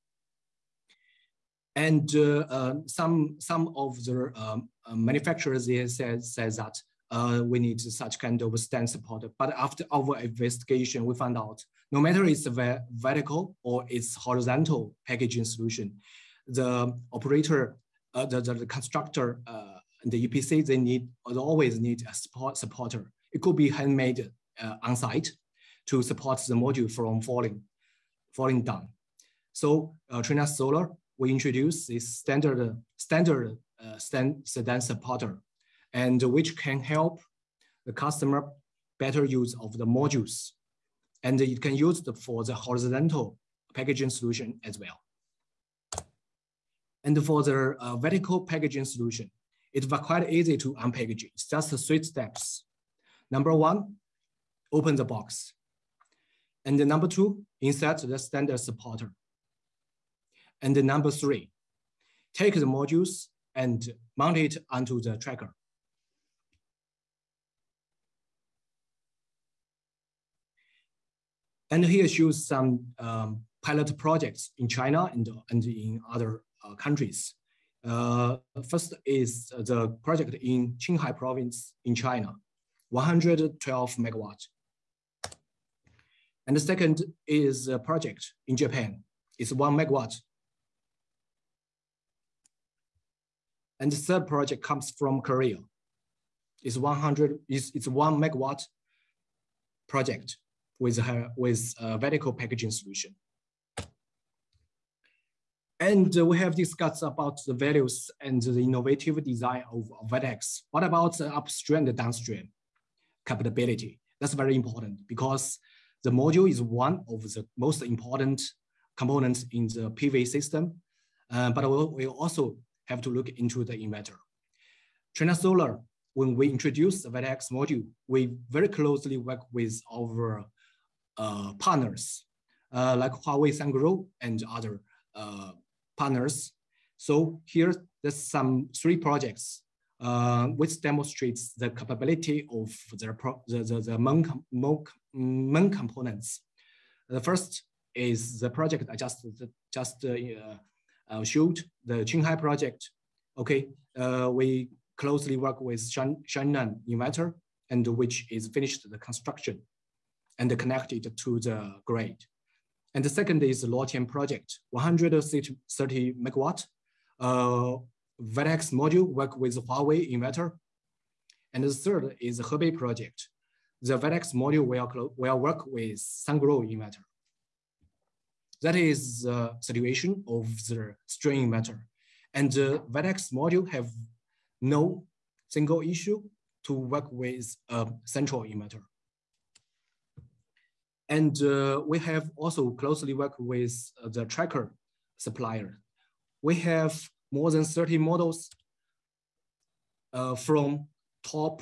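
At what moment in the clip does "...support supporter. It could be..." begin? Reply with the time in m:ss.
0:22.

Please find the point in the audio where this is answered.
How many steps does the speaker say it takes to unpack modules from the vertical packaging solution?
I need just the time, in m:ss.
0:51.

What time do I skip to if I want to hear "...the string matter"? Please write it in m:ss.
3:00.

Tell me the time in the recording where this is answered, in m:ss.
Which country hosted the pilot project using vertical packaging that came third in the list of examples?
1:35.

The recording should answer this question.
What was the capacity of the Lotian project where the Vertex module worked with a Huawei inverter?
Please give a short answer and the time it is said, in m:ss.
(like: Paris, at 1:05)
130 megawatt, at 2:44.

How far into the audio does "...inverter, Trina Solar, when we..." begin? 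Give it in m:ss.
2:03.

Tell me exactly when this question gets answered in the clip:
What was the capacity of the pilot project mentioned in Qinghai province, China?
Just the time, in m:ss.
1:22.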